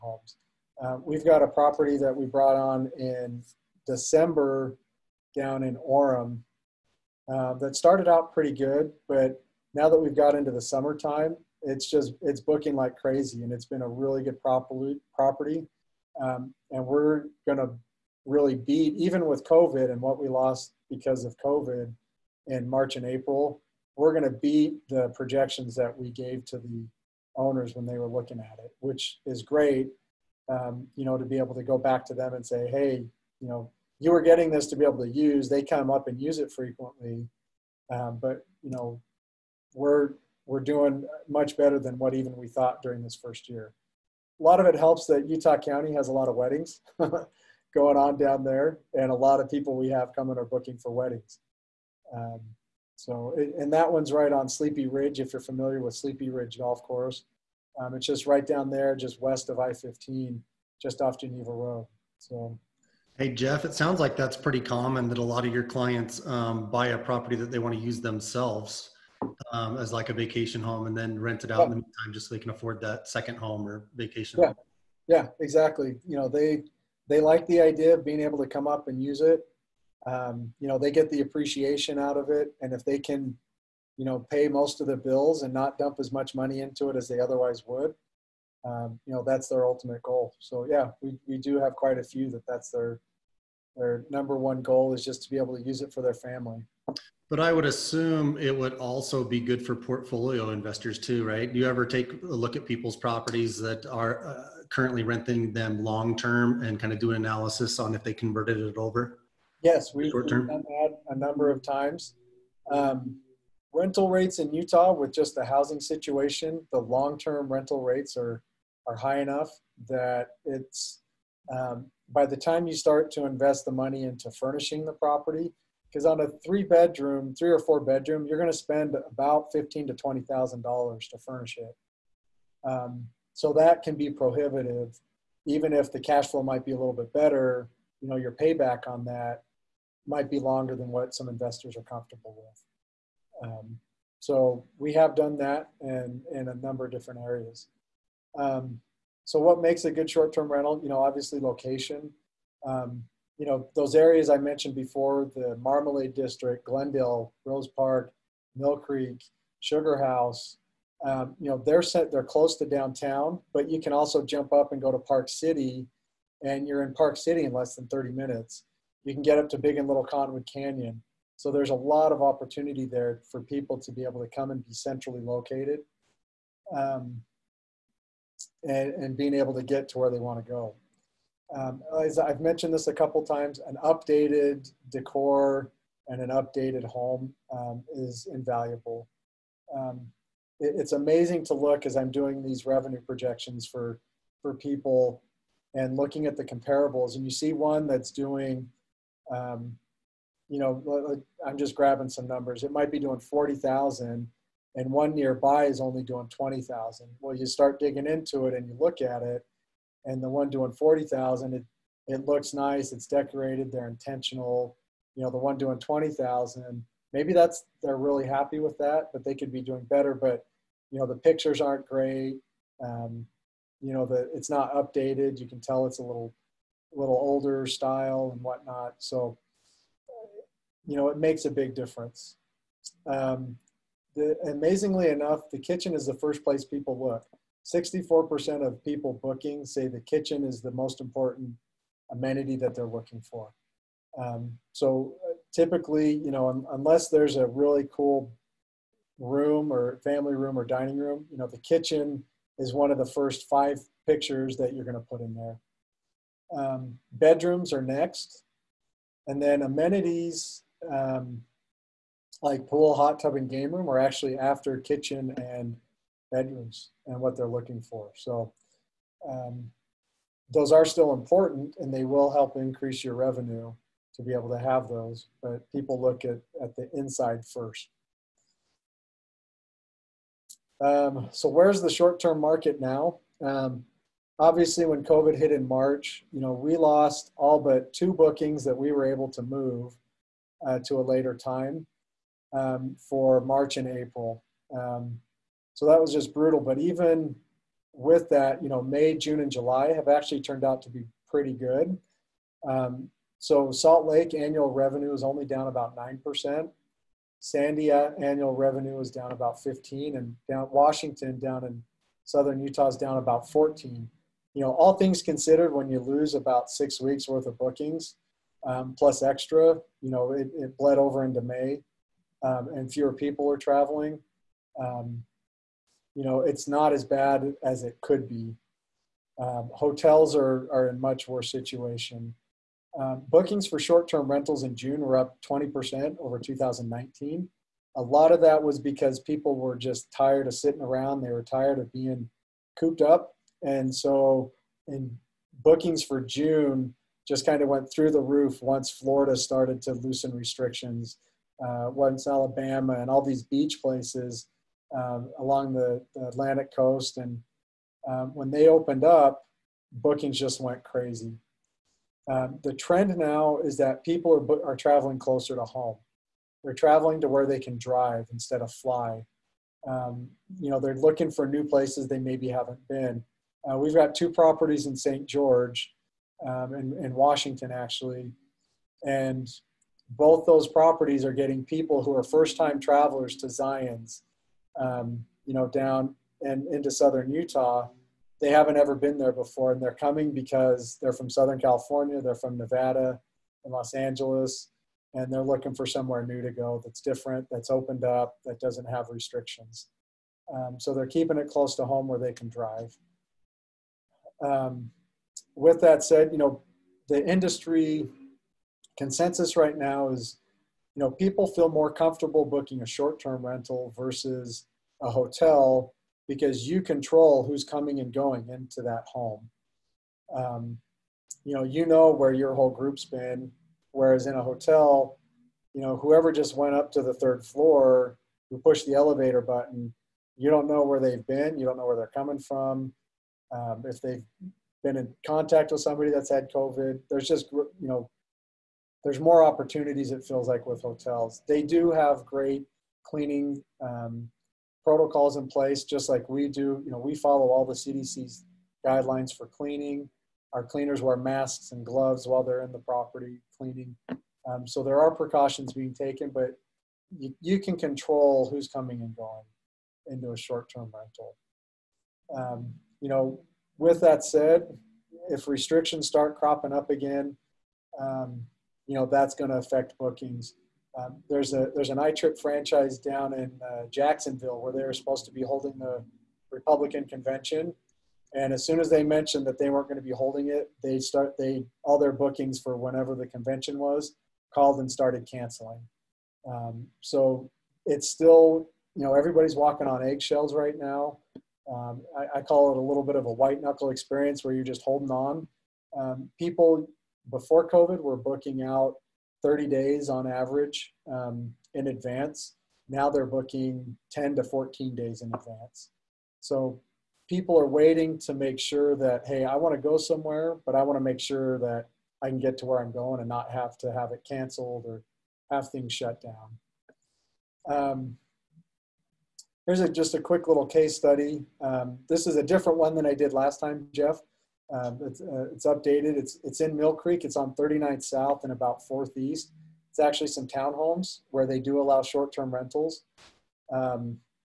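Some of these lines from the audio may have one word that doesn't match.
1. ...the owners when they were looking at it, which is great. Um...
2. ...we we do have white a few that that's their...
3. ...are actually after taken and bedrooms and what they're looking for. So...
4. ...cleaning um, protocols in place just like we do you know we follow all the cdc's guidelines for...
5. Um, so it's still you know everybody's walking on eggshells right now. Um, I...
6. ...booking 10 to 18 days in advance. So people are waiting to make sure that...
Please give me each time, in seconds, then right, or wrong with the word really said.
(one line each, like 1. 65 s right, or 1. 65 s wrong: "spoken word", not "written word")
1. 26 s right
2. 91 s wrong: "quite", not "white"
3. 263 s wrong: "kitchen", not "taken"
4. 443 s right
5. 486 s right
6. 503 s wrong: "14", not "18".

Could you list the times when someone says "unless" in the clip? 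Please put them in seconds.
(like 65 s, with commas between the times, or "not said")
246 s.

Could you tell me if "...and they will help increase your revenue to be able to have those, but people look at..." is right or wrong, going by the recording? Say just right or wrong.
right.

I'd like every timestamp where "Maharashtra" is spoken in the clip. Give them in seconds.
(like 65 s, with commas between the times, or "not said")
not said.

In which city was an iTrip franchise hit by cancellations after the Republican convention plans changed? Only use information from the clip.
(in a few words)
Jacksonville.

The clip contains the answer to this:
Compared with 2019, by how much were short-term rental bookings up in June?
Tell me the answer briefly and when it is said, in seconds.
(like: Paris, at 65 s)
20%, at 335 s.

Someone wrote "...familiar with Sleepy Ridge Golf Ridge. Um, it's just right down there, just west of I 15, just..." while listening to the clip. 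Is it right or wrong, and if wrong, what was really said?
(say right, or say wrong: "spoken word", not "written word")
wrong: "Course", not "Ridge".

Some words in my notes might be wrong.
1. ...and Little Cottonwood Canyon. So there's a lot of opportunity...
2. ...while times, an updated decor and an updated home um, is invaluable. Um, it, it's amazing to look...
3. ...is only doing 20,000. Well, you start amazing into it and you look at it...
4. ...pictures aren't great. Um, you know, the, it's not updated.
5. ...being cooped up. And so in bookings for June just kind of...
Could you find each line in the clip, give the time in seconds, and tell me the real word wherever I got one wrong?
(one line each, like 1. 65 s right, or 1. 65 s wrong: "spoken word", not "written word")
1. 169 s right
2. 182 s wrong: "couple", not "while"
3. 205 s wrong: "digging", not "amazing"
4. 221 s right
5. 341 s right.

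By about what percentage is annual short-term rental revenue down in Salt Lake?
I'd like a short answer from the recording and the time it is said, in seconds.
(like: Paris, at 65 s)
9%, at 305 s.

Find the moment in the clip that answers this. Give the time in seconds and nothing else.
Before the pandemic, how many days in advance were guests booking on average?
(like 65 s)
499 s.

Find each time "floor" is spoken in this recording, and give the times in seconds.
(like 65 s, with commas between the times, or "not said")
427 s.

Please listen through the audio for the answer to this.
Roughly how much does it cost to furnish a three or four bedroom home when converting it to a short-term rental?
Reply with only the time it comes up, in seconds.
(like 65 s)
129 s.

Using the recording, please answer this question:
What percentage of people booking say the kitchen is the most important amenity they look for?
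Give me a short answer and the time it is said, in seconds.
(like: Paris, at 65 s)
64%, at 237 s.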